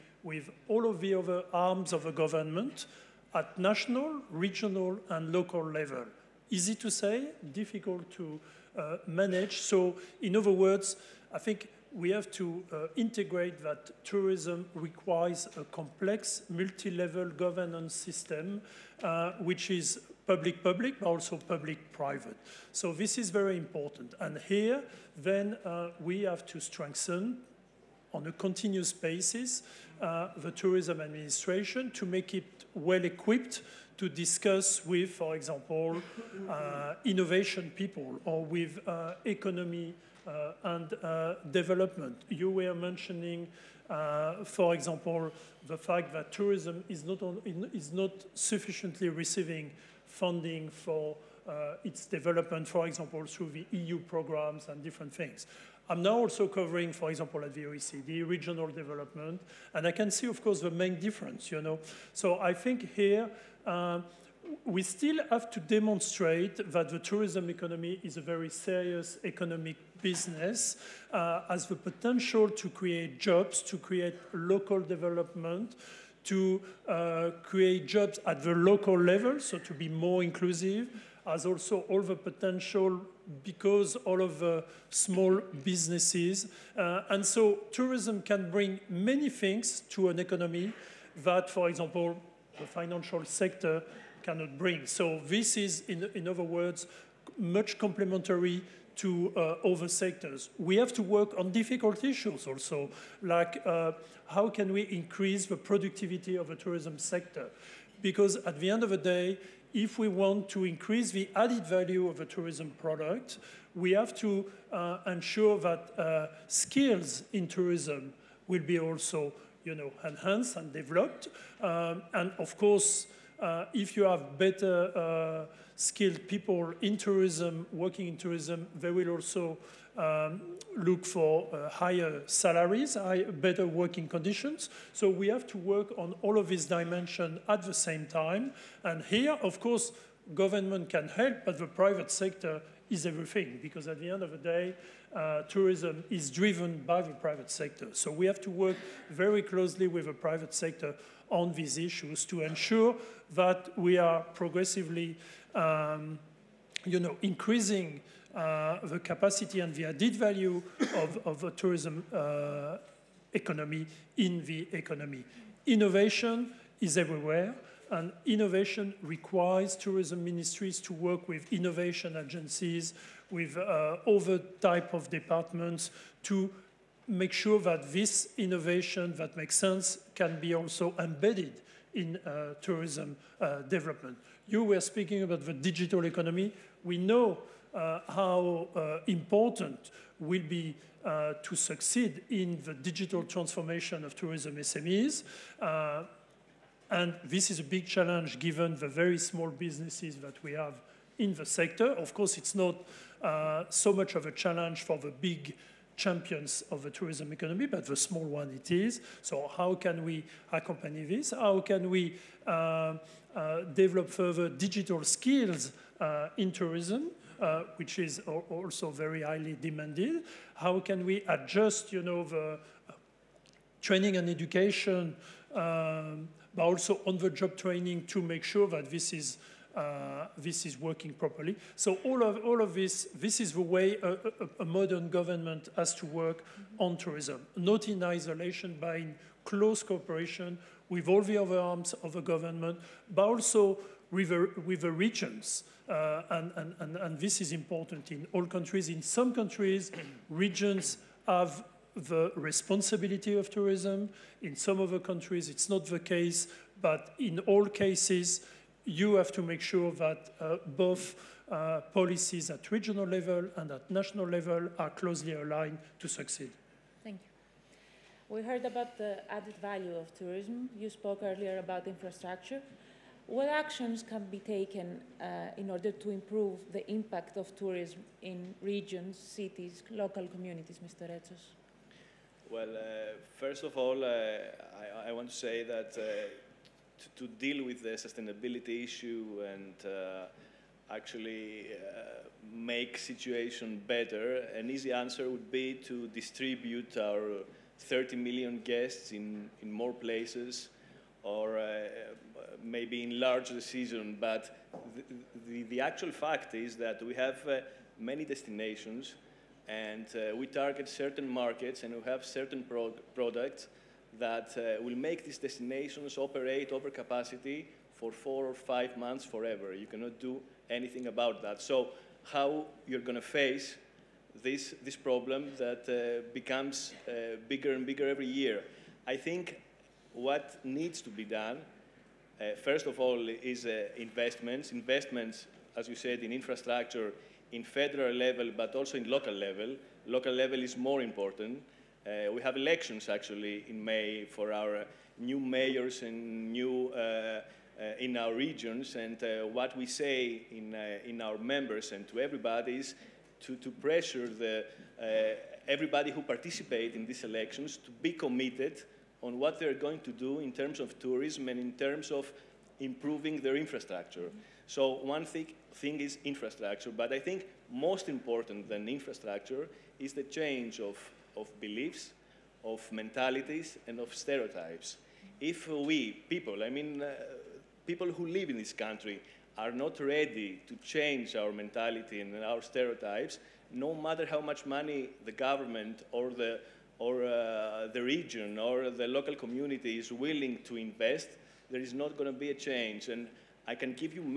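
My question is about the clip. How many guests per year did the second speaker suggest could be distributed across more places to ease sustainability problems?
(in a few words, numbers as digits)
30 million.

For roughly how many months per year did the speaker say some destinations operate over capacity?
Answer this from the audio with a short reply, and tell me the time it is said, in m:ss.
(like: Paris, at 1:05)
4 or 5 months, at 5:18.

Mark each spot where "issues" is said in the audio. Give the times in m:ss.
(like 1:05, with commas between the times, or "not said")
1:42, 2:31, 4:48.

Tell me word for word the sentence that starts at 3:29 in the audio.
So how can we accompany this?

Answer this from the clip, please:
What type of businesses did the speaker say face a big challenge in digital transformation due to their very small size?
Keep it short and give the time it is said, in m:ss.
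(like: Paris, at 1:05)
Tourism SMEs, at 3:14.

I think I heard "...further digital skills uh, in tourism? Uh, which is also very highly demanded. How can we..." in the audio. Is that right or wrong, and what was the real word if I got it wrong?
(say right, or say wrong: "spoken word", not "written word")
right.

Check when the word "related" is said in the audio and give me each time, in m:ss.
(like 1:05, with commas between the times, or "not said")
not said.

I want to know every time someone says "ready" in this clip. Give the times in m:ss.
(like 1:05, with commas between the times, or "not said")
6:20.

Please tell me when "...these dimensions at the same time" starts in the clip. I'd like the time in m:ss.
2:16.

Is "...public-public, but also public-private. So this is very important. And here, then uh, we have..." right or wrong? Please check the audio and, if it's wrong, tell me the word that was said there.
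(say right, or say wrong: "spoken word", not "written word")
right.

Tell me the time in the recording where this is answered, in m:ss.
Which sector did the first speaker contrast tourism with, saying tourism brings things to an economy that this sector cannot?
1:32.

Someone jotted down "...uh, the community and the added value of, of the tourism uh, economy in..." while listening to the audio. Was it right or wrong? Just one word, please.
wrong.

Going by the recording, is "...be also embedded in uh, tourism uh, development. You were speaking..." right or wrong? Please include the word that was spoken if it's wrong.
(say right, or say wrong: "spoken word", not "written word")
right.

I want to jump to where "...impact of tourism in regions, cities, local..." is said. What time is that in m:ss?
4:36.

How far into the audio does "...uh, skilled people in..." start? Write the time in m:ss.
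2:04.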